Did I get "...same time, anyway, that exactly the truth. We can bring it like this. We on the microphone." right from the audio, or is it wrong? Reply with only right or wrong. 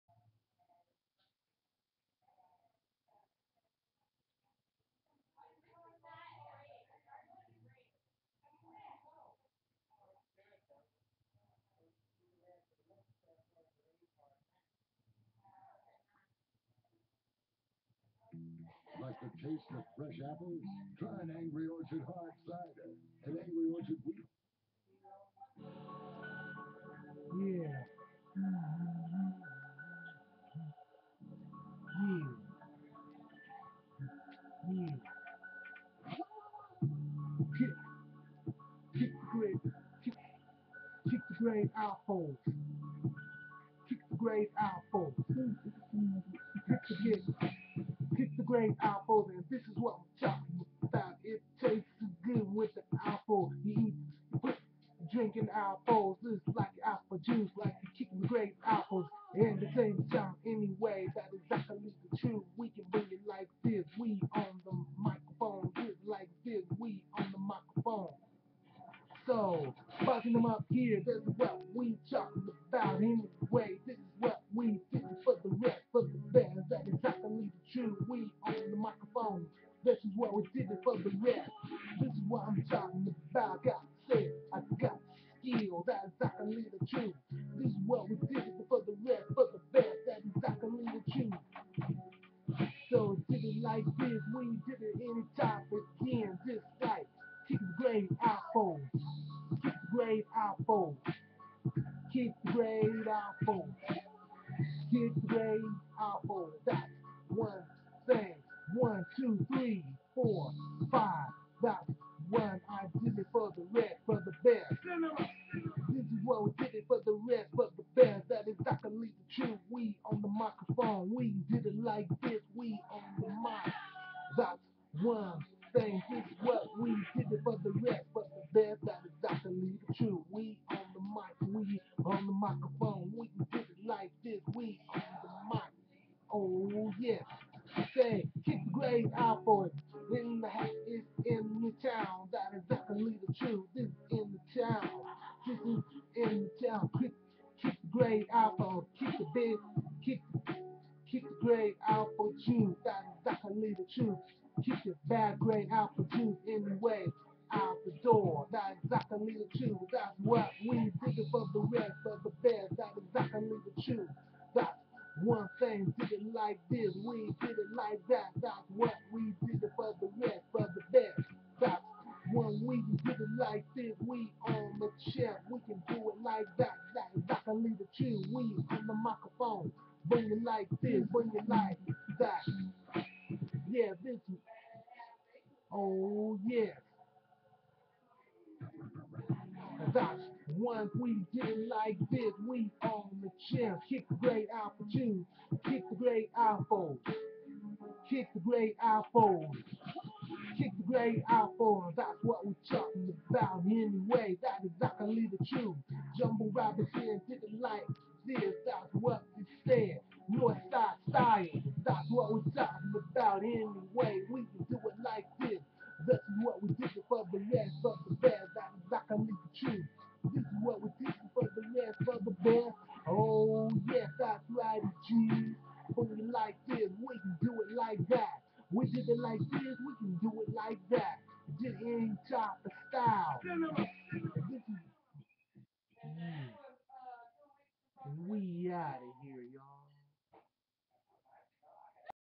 right.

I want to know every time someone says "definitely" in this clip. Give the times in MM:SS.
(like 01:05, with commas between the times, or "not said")
02:22, 02:33.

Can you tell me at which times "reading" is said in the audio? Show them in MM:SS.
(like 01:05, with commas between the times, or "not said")
not said.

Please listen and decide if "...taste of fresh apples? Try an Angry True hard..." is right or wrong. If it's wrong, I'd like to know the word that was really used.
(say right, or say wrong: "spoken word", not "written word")
wrong: "Orchard", not "True".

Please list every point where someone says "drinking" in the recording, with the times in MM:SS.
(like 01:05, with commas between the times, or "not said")
00:55.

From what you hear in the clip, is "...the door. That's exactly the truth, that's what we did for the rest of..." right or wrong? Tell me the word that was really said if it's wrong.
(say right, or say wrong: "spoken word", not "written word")
right.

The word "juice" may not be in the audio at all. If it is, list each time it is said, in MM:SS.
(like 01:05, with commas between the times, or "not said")
00:57.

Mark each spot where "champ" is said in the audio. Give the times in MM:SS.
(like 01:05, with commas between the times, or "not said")
03:13.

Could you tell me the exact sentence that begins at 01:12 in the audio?
Anyway, this is what we did for the rest.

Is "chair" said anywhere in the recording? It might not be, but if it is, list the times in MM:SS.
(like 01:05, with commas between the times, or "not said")
02:55.